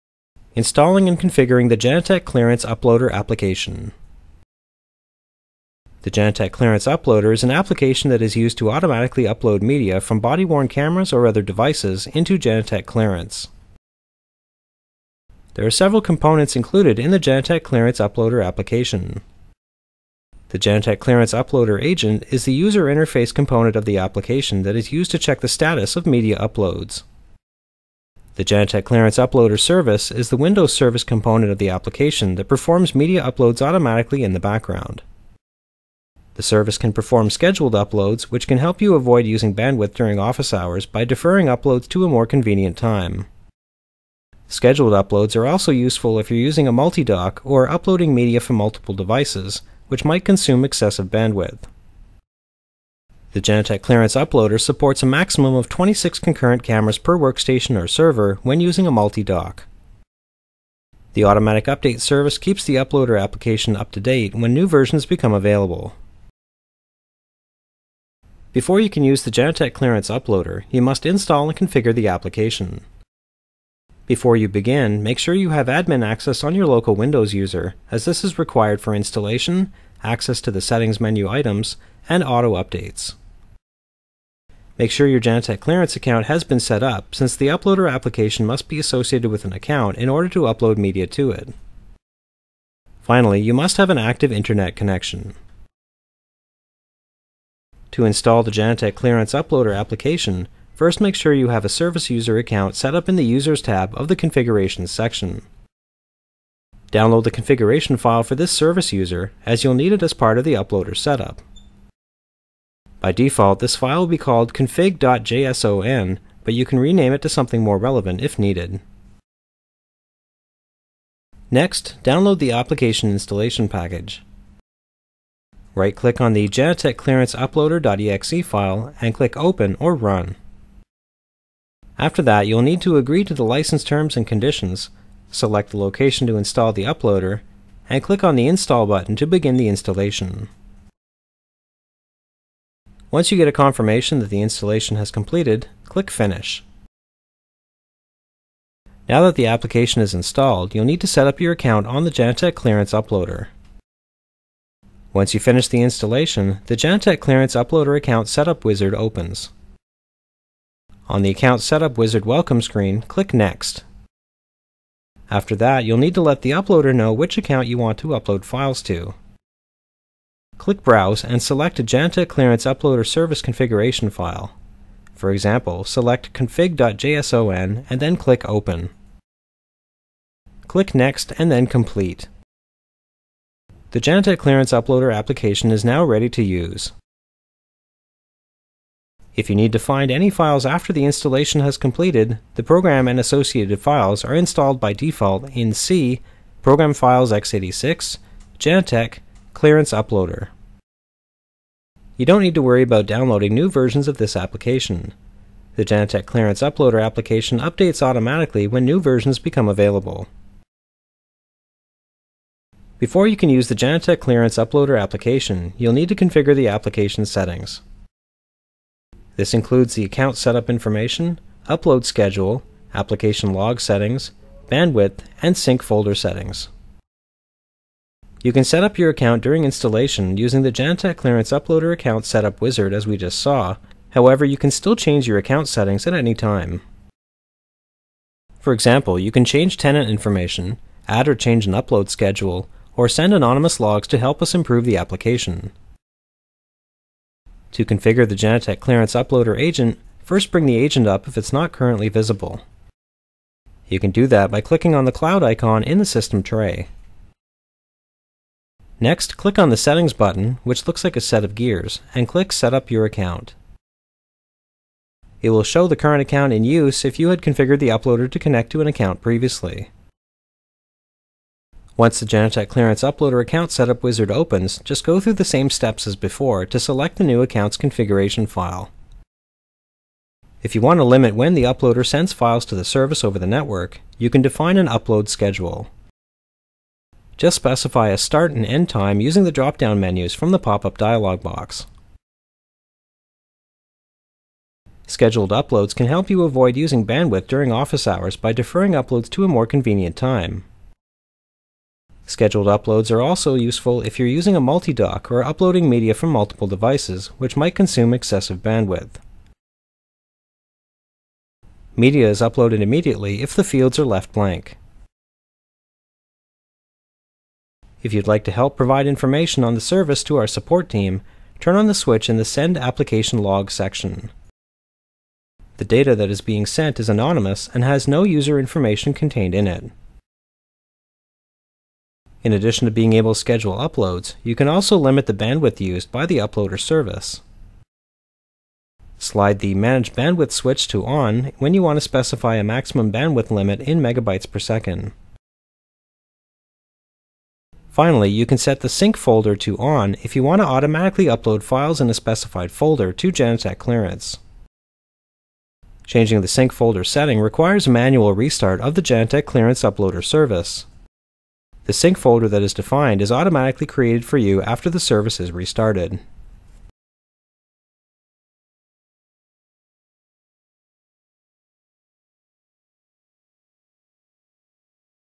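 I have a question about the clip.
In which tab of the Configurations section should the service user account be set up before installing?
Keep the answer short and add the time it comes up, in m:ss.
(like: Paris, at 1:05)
Users, at 1:43.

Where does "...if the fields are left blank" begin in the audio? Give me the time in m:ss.
5:13.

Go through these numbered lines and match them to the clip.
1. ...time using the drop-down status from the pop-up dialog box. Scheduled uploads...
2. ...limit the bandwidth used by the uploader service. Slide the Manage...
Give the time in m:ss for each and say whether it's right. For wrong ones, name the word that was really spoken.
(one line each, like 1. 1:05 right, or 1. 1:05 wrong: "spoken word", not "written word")
1. 4:48 wrong: "menus", not "status"
2. 5:34 right.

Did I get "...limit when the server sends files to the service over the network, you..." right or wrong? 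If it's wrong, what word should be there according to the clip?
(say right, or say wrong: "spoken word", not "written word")
wrong: "uploader", not "server".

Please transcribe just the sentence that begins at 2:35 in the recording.
Once you finish the installation, the Genetec Clearance Uploader Account Setup Wizard opens.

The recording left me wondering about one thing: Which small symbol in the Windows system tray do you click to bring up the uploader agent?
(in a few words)
cloud icon.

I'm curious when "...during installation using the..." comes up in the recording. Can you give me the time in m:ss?
3:49.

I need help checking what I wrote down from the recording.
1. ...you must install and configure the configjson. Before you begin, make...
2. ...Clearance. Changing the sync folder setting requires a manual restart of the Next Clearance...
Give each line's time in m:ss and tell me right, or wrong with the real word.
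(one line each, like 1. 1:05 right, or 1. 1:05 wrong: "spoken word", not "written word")
1. 1:10 wrong: "application", not "configjson"
2. 5:53 wrong: "Genetec", not "Next".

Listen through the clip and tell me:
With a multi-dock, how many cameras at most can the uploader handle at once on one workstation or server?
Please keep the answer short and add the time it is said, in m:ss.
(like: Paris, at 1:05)
26, at 0:55.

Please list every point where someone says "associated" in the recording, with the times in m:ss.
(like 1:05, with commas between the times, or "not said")
1:28, 3:13.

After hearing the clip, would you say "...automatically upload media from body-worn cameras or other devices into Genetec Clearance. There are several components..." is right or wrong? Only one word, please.
right.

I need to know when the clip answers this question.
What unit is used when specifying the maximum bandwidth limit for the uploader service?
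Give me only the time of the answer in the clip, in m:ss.
5:44.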